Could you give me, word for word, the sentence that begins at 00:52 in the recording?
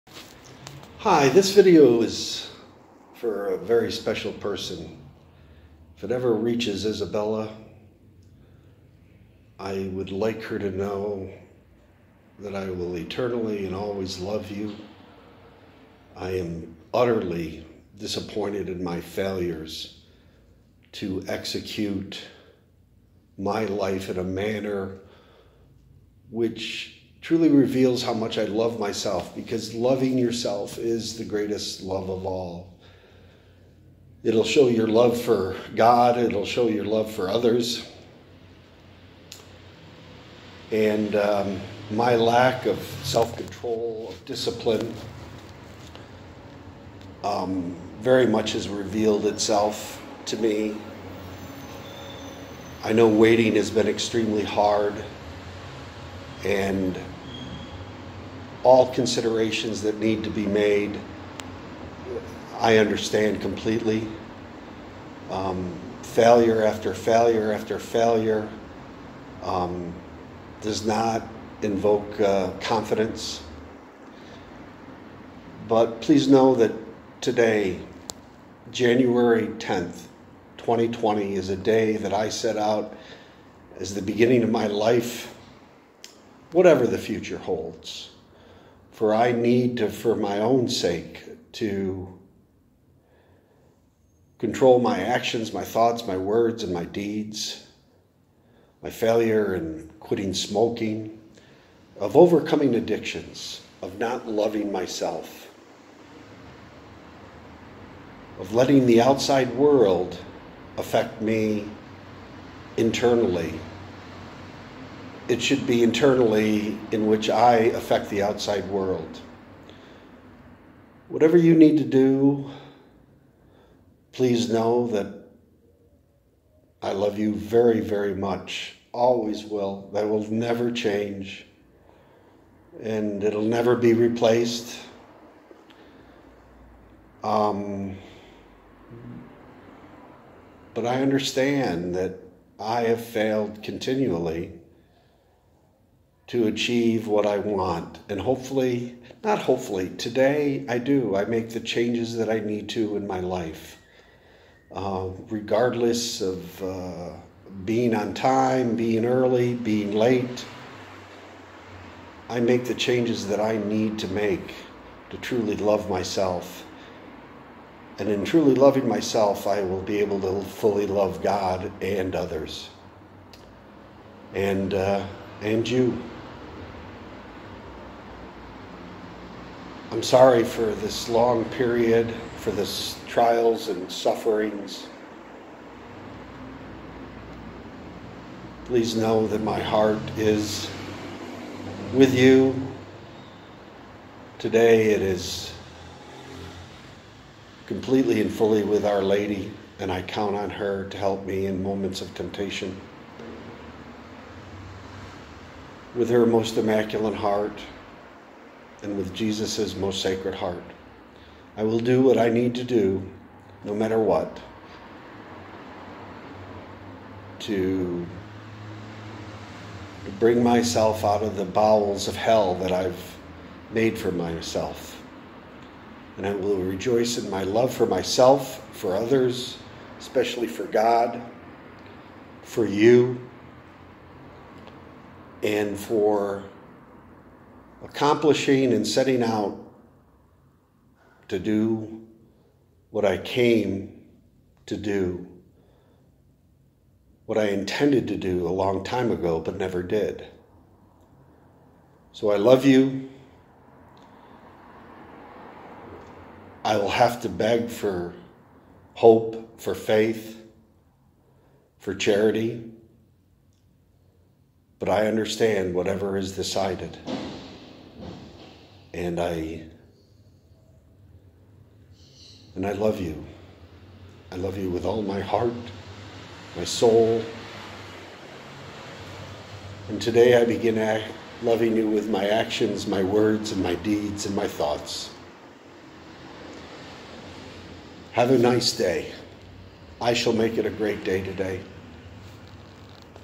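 I know waiting has been extremely hard and all considerations that need to be made, I understand completely.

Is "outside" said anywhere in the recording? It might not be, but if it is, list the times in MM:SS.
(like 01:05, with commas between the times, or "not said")
01:49, 01:58.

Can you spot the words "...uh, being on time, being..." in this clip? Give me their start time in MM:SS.
02:36.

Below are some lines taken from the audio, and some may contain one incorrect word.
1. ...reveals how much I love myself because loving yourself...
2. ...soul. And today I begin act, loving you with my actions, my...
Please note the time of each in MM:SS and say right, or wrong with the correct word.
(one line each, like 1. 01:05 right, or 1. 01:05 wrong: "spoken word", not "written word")
1. 00:27 right
2. 04:36 right.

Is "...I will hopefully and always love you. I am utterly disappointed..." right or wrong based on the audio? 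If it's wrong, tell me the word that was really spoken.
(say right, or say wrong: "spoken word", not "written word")
wrong: "eternally", not "hopefully".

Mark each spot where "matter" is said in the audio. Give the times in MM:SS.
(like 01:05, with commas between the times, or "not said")
03:33.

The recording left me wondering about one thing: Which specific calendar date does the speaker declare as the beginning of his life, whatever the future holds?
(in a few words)
January 10, 2020.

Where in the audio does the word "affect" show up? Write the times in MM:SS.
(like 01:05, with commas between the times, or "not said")
01:50, 01:57.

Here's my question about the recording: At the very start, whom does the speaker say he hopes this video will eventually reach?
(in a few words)
Isabella.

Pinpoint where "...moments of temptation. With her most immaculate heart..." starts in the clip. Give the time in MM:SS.
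03:21.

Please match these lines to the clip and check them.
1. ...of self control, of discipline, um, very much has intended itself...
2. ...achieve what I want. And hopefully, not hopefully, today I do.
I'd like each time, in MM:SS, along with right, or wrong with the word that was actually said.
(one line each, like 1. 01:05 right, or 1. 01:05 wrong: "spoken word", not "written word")
1. 00:42 wrong: "revealed", not "intended"
2. 02:26 right.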